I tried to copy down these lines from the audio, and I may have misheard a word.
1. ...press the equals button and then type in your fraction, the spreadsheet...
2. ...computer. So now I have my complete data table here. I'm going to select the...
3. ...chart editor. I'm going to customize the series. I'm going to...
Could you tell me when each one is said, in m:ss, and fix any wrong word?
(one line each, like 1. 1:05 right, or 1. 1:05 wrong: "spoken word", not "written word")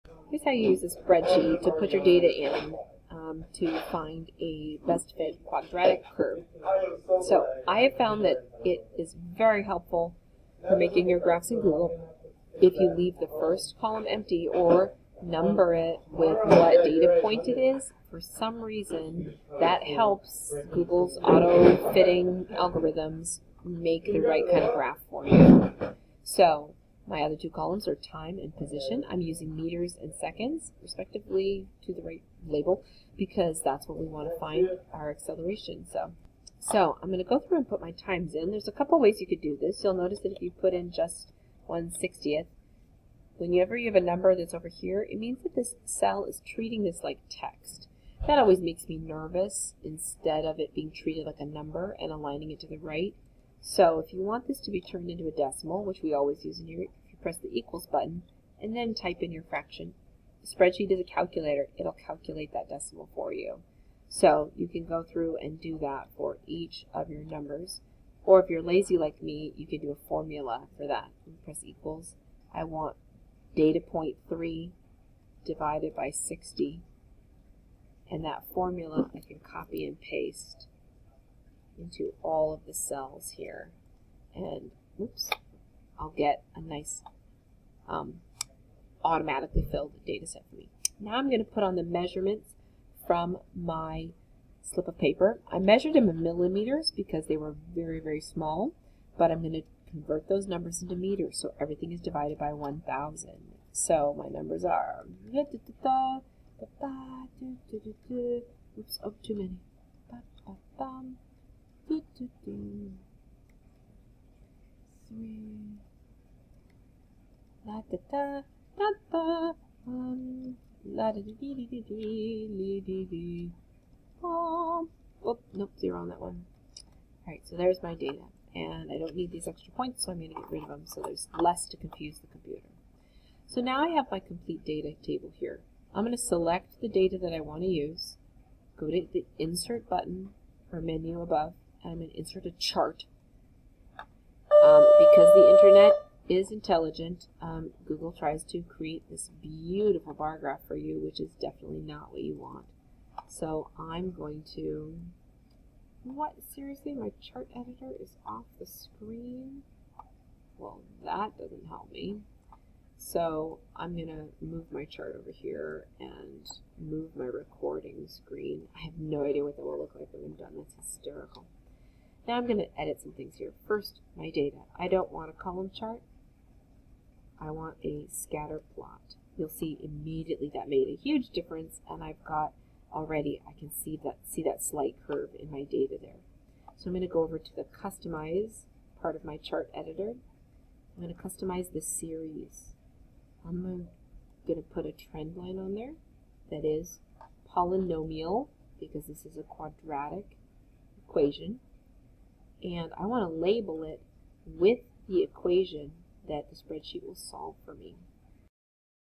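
1. 0:57 right
2. 2:12 right
3. 3:09 right.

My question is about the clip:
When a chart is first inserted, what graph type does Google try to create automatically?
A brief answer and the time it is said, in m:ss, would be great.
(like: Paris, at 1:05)
bar graph, at 2:30.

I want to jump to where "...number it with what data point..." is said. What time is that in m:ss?
0:15.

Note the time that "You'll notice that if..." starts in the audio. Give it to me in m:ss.
0:39.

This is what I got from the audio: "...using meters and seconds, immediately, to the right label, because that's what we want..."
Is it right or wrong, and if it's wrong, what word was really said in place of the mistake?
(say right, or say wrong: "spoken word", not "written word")
wrong: "respectively", not "immediately".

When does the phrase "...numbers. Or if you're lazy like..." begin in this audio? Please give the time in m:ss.
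1:07.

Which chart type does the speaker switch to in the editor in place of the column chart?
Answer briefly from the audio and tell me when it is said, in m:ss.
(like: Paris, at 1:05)
scatter plot, at 2:58.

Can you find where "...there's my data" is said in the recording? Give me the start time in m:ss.
2:07.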